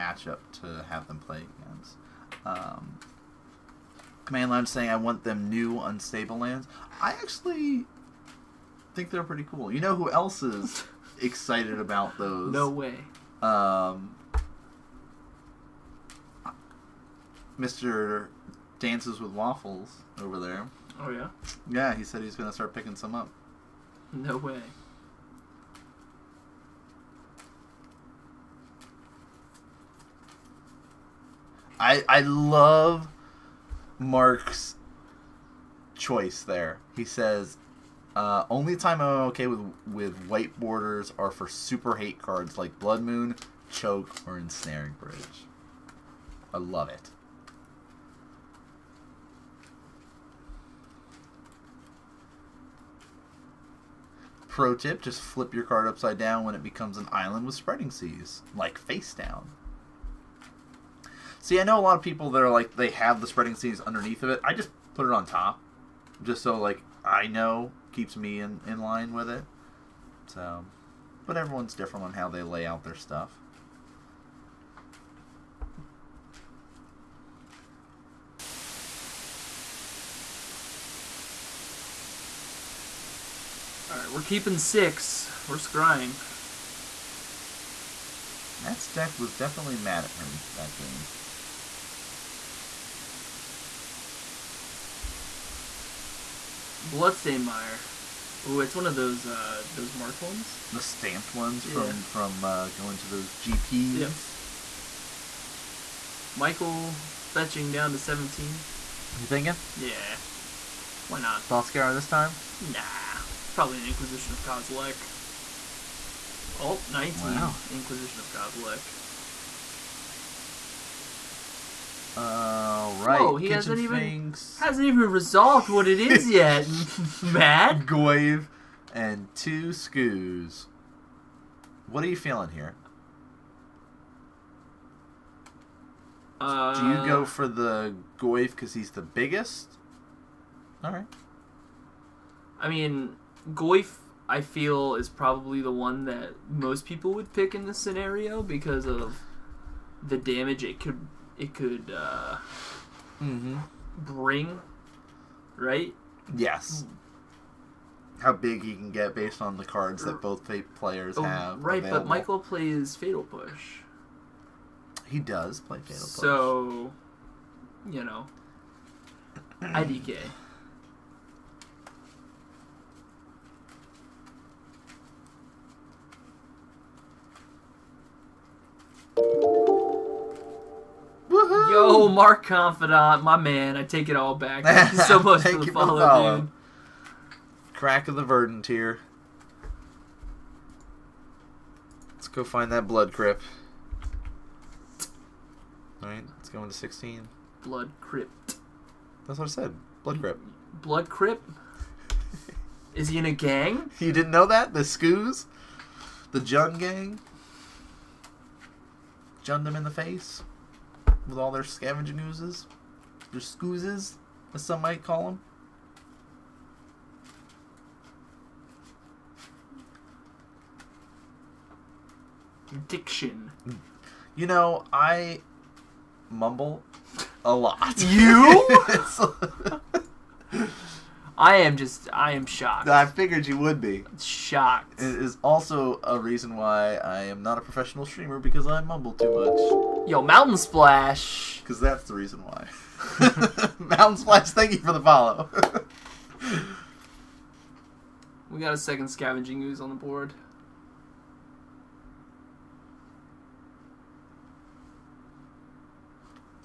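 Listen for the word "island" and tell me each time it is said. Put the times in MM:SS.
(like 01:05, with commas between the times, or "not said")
00:57.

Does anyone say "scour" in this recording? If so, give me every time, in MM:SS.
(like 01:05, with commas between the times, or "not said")
01:51.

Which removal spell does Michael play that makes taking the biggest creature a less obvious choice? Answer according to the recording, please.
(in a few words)
Fatal Push.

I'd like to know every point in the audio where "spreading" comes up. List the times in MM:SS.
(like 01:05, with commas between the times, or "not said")
00:57, 01:03.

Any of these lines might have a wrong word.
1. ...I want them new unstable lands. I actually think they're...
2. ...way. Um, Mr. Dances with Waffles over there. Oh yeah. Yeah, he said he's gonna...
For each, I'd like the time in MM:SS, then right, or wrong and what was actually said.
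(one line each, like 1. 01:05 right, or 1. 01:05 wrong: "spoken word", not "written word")
1. 00:04 right
2. 00:12 right.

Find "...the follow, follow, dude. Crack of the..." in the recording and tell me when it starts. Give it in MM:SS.
03:05.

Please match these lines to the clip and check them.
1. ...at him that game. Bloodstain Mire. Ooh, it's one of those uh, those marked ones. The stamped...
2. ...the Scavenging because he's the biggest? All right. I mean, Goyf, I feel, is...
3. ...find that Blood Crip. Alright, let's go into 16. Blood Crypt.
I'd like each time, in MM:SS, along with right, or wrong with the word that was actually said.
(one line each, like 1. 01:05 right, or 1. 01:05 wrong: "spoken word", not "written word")
1. 01:30 right
2. 02:17 wrong: "Goyf", not "Scavenging"
3. 03:12 right.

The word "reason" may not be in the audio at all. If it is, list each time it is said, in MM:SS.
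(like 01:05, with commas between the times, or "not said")
03:56, 04:02.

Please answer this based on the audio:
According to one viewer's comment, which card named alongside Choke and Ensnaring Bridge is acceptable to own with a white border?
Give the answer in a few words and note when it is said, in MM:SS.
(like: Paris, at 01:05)
Blood Moon, at 00:42.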